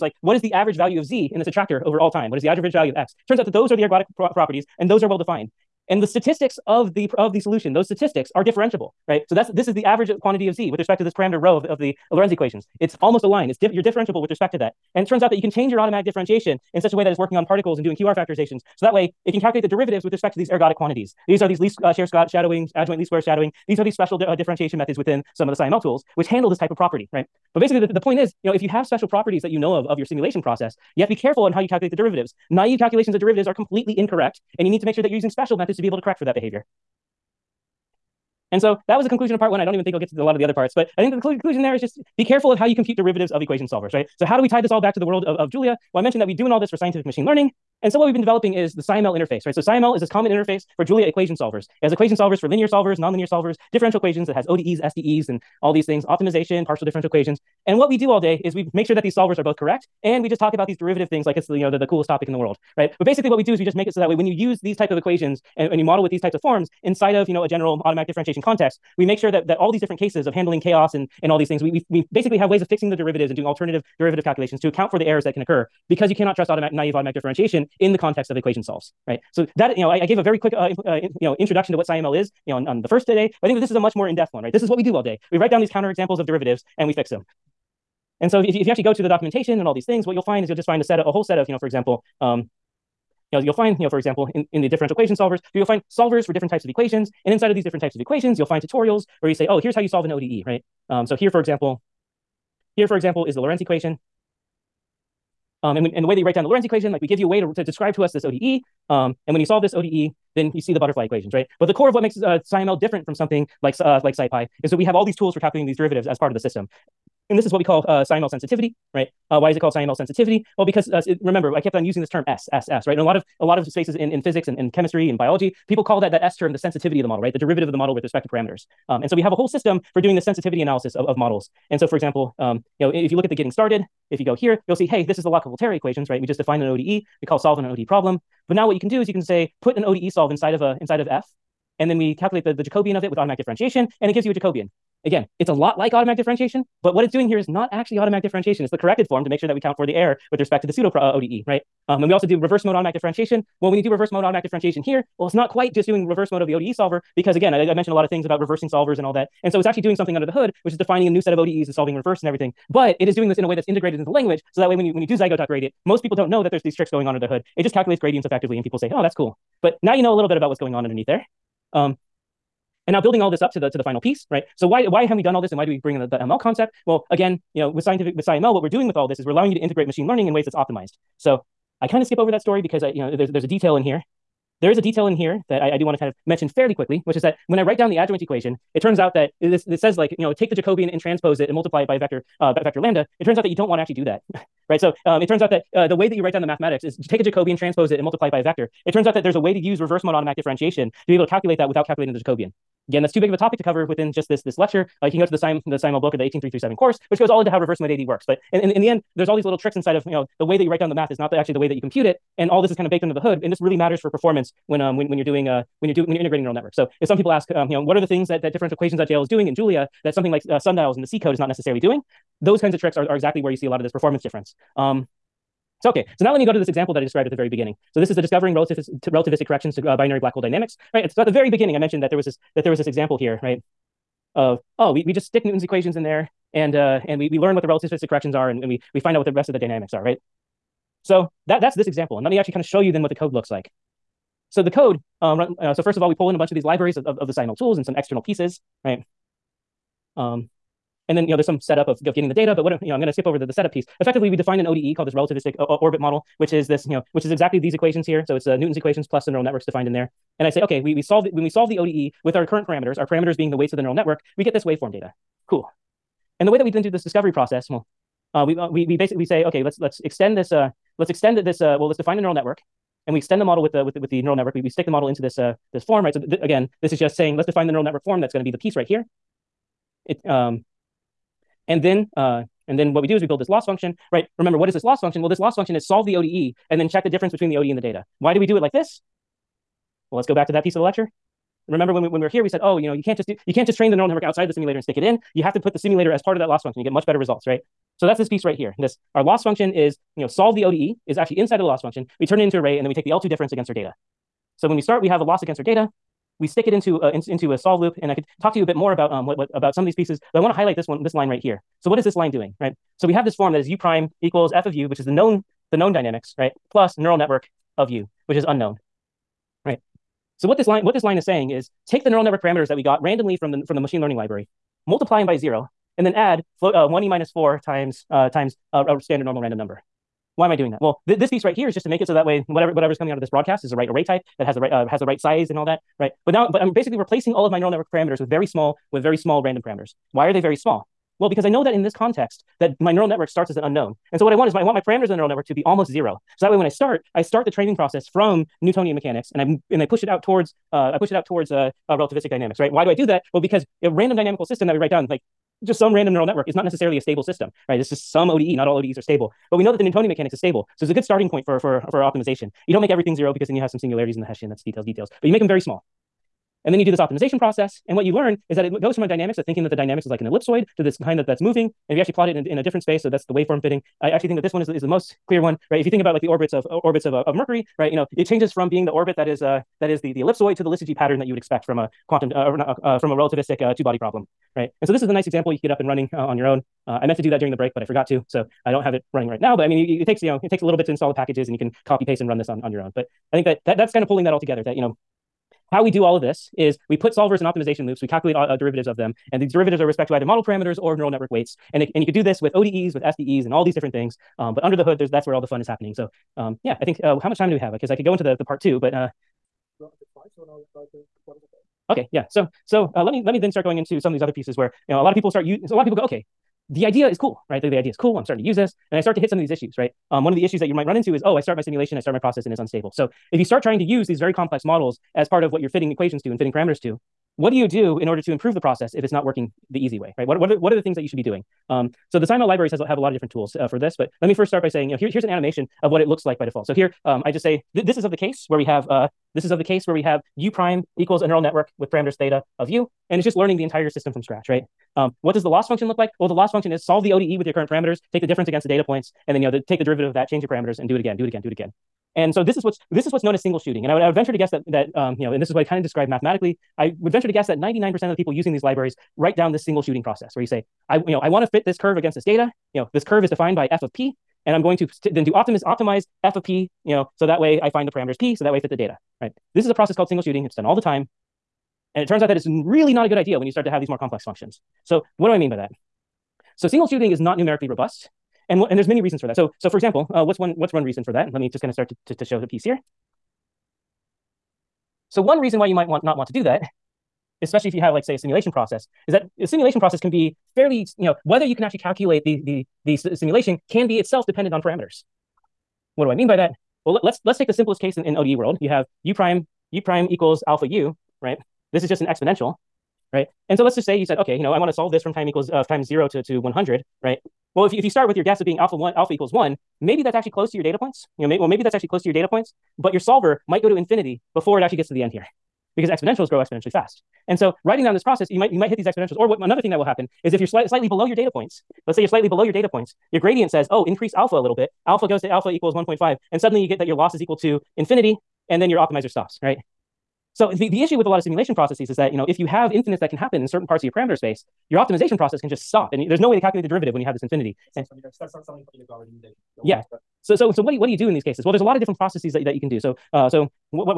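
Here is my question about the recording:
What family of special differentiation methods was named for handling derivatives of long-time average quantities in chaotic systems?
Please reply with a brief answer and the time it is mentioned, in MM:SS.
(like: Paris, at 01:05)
adjoint least square shadowing, at 00:22.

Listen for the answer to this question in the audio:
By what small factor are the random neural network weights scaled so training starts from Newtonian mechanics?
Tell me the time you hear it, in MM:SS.
05:26.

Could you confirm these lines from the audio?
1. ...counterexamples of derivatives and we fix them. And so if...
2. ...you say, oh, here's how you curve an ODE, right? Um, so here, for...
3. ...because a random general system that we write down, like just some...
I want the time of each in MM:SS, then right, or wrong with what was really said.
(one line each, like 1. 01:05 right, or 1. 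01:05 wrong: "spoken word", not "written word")
1. 01:25 right
2. 01:39 wrong: "solve", not "curve"
3. 05:53 wrong: "dynamical", not "general".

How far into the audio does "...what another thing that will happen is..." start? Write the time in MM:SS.
08:39.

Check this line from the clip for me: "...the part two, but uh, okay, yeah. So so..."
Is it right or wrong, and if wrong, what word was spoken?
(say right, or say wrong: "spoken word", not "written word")
right.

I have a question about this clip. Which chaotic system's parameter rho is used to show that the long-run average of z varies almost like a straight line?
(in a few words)
Lorenz equations.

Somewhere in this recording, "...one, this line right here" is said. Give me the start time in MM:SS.
05:10.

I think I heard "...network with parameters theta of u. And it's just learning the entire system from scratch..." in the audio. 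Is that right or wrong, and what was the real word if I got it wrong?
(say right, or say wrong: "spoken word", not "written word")
right.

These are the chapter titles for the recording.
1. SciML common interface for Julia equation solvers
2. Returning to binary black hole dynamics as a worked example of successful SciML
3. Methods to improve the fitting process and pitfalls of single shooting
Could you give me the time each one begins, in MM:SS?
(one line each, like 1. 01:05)
1. 00:45
2. 03:48
3. 06:54.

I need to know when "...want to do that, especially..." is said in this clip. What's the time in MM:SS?
08:06.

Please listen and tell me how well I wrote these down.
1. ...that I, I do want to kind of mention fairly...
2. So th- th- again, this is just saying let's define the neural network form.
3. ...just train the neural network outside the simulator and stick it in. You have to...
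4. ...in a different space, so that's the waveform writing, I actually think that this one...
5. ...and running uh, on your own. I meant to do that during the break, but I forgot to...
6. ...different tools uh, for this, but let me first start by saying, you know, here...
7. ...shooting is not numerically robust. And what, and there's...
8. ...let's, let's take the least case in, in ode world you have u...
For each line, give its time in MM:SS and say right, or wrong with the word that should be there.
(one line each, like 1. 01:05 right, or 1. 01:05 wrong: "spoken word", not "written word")
1. 03:05 right
2. 04:36 right
3. 04:53 right
4. 06:12 wrong: "fitting", not "writing"
5. 06:25 right
6. 07:13 right
7. 07:56 right
8. 08:17 wrong: "simplest", not "least".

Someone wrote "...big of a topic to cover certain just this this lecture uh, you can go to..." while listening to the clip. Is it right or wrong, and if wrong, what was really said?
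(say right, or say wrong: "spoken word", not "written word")
wrong: "within", not "certain".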